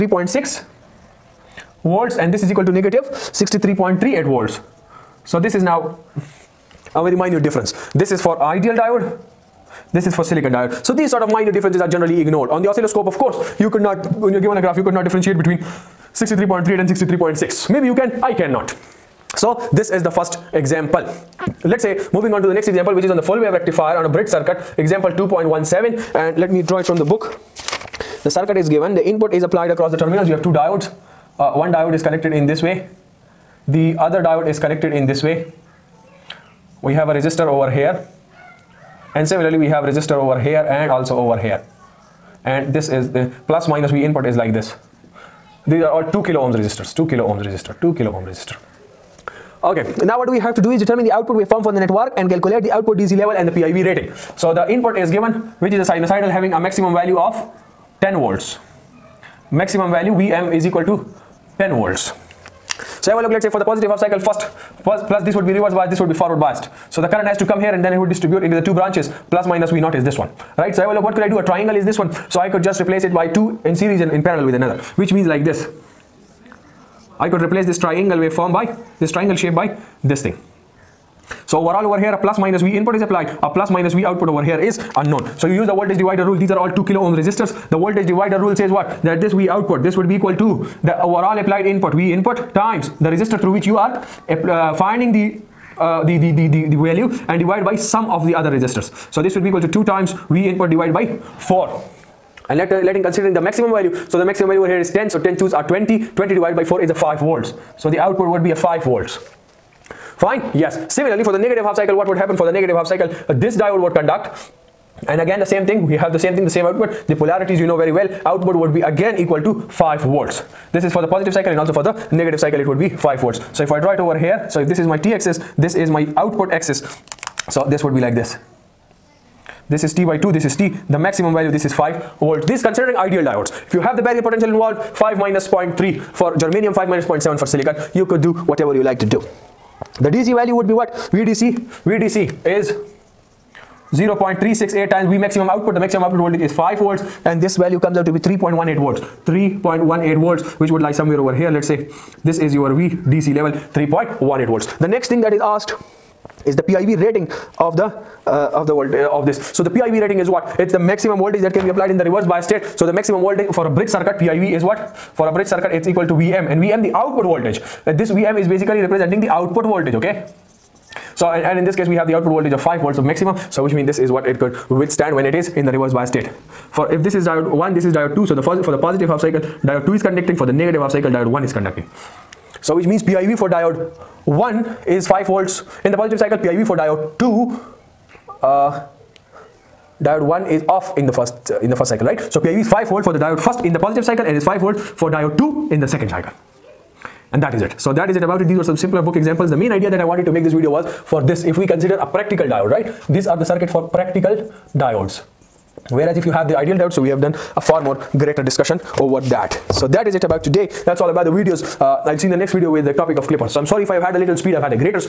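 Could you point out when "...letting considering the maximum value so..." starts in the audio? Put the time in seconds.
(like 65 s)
102 s.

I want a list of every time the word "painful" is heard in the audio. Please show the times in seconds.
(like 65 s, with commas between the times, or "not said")
not said.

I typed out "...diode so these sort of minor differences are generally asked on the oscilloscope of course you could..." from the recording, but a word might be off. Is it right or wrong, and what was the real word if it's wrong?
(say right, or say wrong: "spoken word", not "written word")
wrong: "ignored", not "asked".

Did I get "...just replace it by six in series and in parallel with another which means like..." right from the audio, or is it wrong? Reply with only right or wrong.
wrong.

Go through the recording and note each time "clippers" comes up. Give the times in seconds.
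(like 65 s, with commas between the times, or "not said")
213 s.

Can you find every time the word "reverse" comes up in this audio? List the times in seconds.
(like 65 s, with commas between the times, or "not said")
65 s, 162 s, 175 s.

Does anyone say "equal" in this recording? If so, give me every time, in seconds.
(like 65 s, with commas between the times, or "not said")
2 s, 60 s, 90 s, 99 s, 119 s, 165 s.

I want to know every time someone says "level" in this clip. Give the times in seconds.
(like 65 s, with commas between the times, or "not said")
53 s, 153 s.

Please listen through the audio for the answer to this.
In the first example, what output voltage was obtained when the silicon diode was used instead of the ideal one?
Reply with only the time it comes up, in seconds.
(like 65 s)
2 s.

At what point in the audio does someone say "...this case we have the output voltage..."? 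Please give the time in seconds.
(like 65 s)
171 s.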